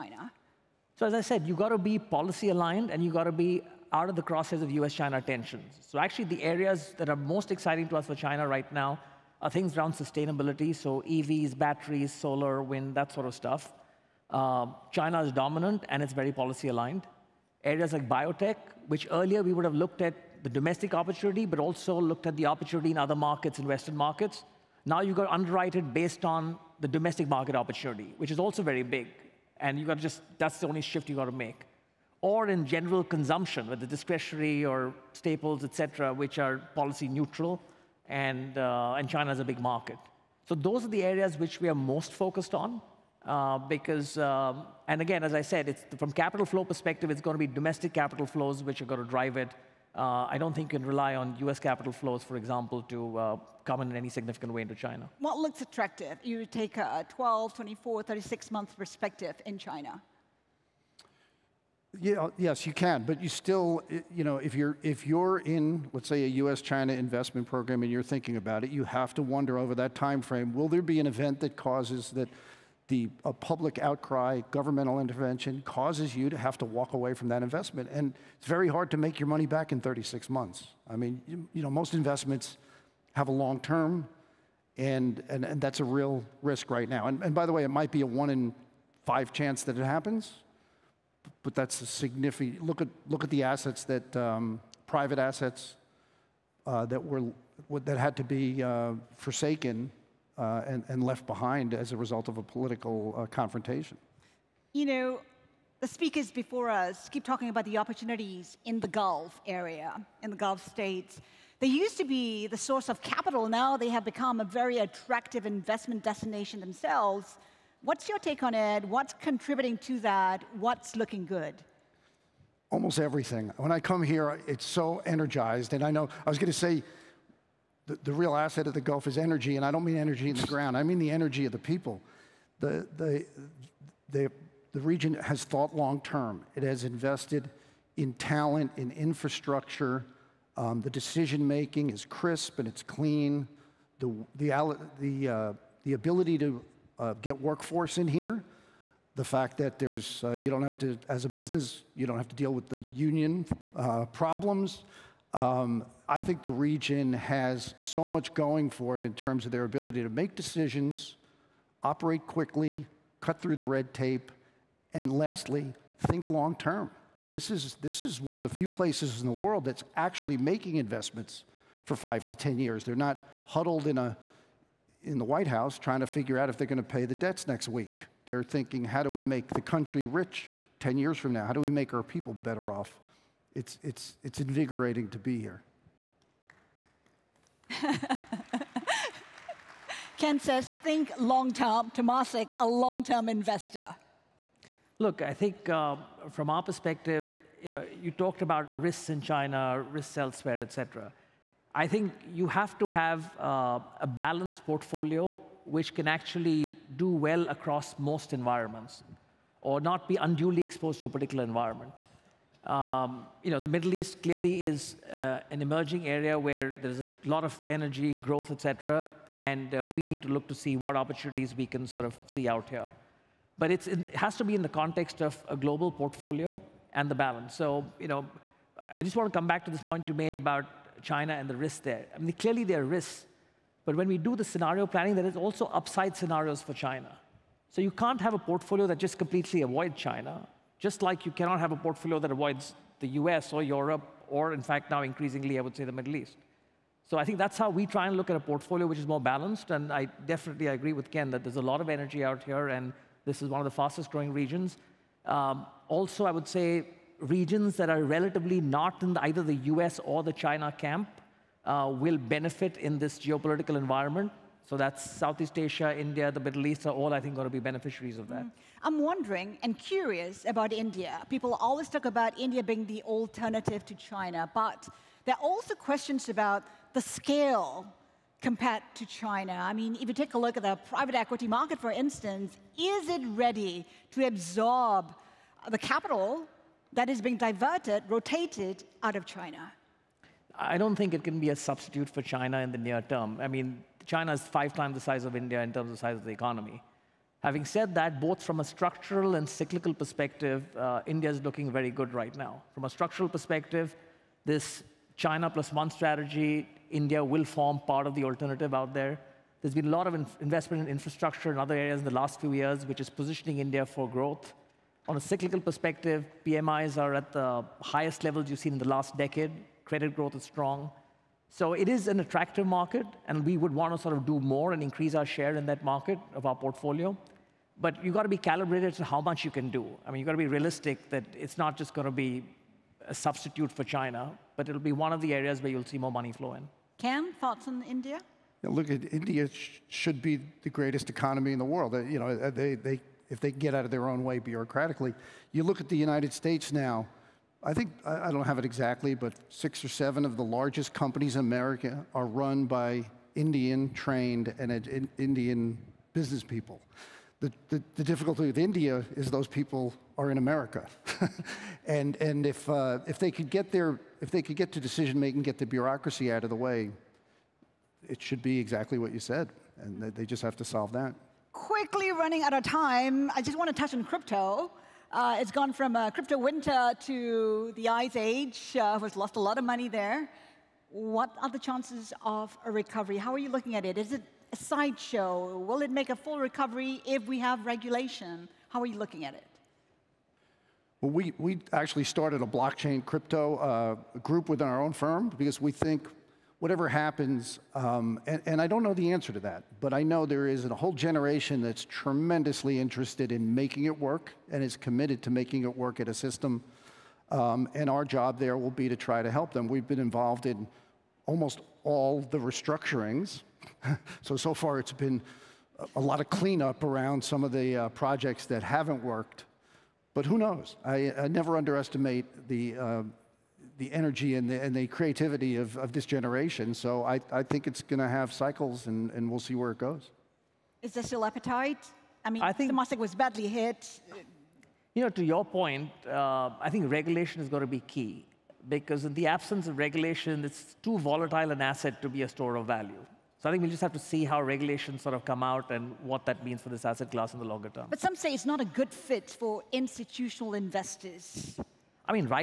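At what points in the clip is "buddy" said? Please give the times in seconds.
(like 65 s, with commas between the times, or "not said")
not said.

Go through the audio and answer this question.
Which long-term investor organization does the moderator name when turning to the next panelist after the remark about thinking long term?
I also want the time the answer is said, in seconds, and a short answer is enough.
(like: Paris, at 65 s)
Temasek, at 191 s.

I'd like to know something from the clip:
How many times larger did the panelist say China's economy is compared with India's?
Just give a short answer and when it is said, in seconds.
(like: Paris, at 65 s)
5 times, at 294 s.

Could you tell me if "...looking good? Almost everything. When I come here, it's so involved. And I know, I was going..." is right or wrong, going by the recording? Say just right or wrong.
wrong.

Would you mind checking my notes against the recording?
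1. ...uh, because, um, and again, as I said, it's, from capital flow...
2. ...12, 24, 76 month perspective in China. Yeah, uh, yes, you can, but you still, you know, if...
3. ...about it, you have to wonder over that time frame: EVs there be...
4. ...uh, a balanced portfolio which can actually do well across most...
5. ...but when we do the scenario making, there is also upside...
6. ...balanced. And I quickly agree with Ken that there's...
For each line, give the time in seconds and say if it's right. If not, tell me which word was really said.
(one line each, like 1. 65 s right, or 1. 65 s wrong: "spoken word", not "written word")
1. 43 s right
2. 57 s wrong: "36", not "76"
3. 68 s wrong: "Will", not "EVs"
4. 203 s right
5. 233 s wrong: "planning", not "making"
6. 249 s wrong: "definitely", not "quickly".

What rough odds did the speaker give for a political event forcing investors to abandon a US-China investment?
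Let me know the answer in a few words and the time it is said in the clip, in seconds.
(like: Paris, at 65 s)
One in five, at 88 s.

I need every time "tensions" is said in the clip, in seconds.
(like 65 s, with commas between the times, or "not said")
5 s.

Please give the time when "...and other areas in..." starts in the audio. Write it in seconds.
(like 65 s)
311 s.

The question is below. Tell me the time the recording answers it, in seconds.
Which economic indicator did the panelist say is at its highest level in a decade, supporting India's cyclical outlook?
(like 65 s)
316 s.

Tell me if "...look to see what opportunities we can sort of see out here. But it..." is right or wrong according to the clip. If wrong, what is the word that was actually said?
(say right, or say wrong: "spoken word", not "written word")
right.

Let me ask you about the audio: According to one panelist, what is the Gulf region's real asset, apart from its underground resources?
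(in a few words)
Energy of the people.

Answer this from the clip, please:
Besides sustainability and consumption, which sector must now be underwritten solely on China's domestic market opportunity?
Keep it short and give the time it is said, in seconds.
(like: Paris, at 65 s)
Biotech, at 18 s.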